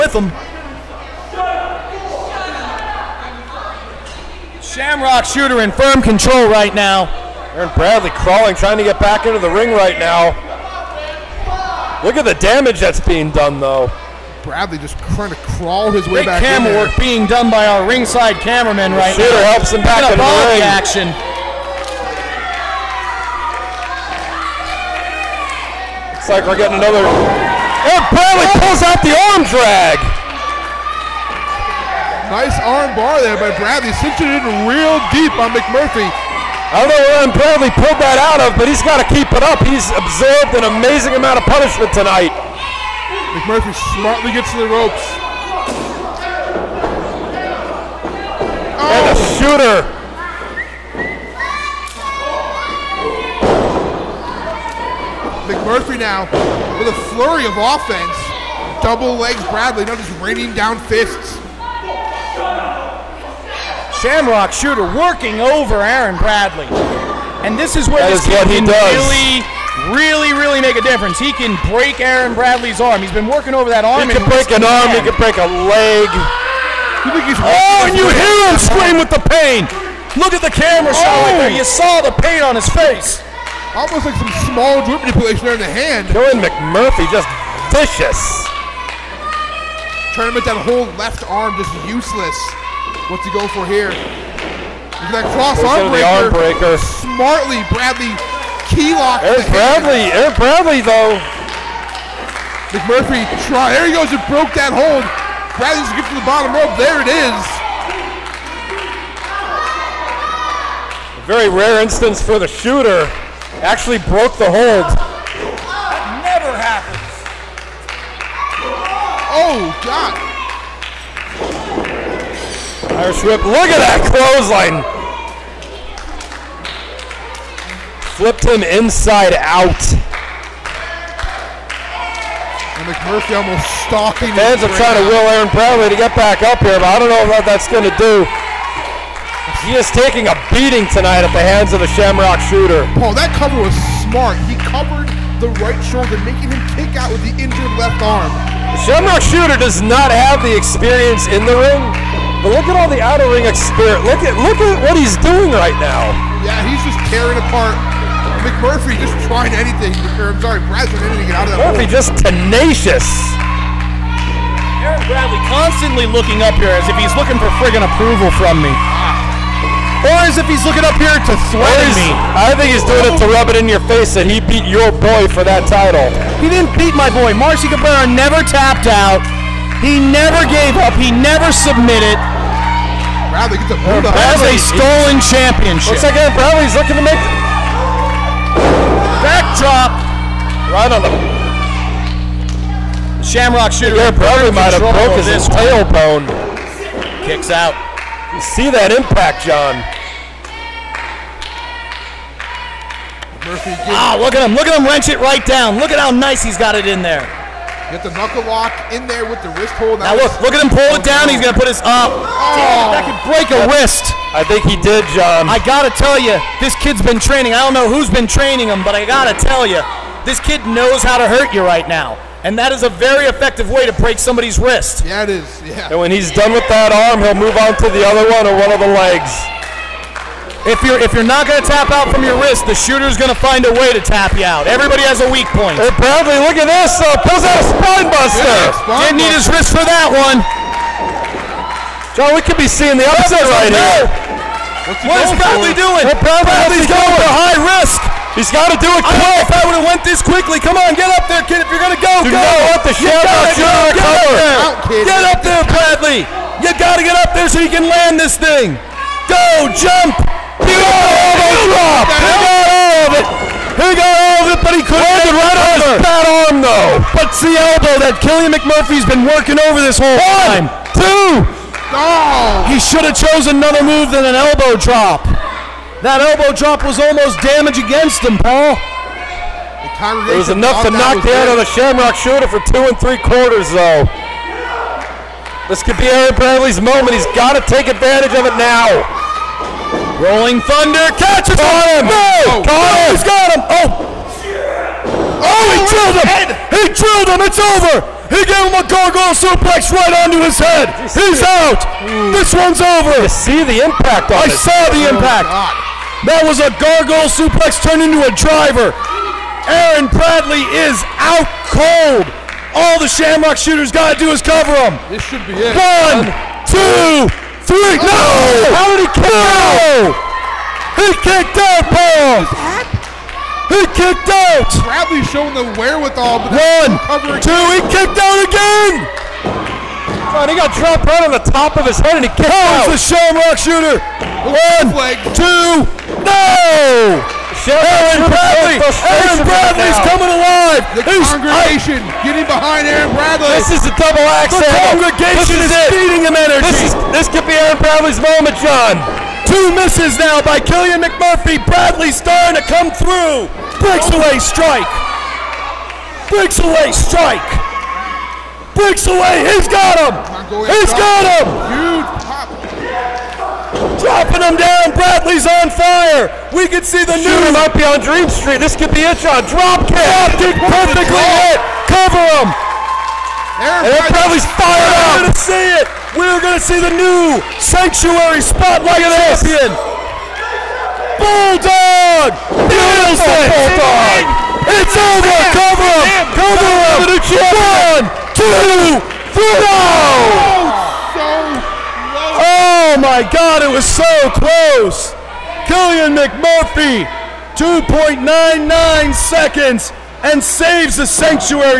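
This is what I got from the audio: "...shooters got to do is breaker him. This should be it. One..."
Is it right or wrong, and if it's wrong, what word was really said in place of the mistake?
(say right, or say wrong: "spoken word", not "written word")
wrong: "cover", not "breaker".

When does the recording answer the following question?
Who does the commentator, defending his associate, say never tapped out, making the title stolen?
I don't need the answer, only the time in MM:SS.
02:57.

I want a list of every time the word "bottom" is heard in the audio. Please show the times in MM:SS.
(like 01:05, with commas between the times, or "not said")
01:46.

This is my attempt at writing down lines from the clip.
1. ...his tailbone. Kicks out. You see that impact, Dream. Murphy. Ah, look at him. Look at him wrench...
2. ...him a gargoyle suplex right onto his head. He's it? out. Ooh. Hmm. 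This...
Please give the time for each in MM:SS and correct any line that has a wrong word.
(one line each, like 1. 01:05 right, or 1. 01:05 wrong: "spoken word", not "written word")
1. 03:15 wrong: "John", not "Dream"
2. 04:58 right.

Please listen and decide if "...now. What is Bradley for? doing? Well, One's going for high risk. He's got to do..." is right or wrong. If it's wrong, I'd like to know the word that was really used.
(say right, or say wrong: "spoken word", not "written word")
wrong: "Bradley", not "One".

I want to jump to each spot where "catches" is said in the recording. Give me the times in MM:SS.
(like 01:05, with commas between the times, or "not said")
04:51.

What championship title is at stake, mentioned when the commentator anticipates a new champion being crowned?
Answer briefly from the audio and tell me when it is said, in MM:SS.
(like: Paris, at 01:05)
Sanctuary Spotlight, at 06:17.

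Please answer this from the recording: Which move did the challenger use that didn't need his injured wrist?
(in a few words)
Spine buster.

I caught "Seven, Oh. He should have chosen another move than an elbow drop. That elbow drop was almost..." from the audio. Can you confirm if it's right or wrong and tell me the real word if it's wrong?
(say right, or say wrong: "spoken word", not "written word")
wrong: "Two", not "Seven".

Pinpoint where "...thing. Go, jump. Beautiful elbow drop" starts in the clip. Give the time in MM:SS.
04:18.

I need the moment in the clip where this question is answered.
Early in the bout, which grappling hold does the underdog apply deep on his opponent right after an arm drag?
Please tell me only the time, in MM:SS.
00:32.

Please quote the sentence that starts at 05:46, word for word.
This, is, this could be Aaron Bradley's moment, John!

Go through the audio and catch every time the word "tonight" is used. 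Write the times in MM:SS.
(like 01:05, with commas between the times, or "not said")
00:41, 02:20.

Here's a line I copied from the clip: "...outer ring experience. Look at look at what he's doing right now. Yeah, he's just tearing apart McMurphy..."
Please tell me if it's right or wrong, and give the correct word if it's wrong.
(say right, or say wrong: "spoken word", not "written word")
right.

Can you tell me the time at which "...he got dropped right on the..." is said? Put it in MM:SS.
05:30.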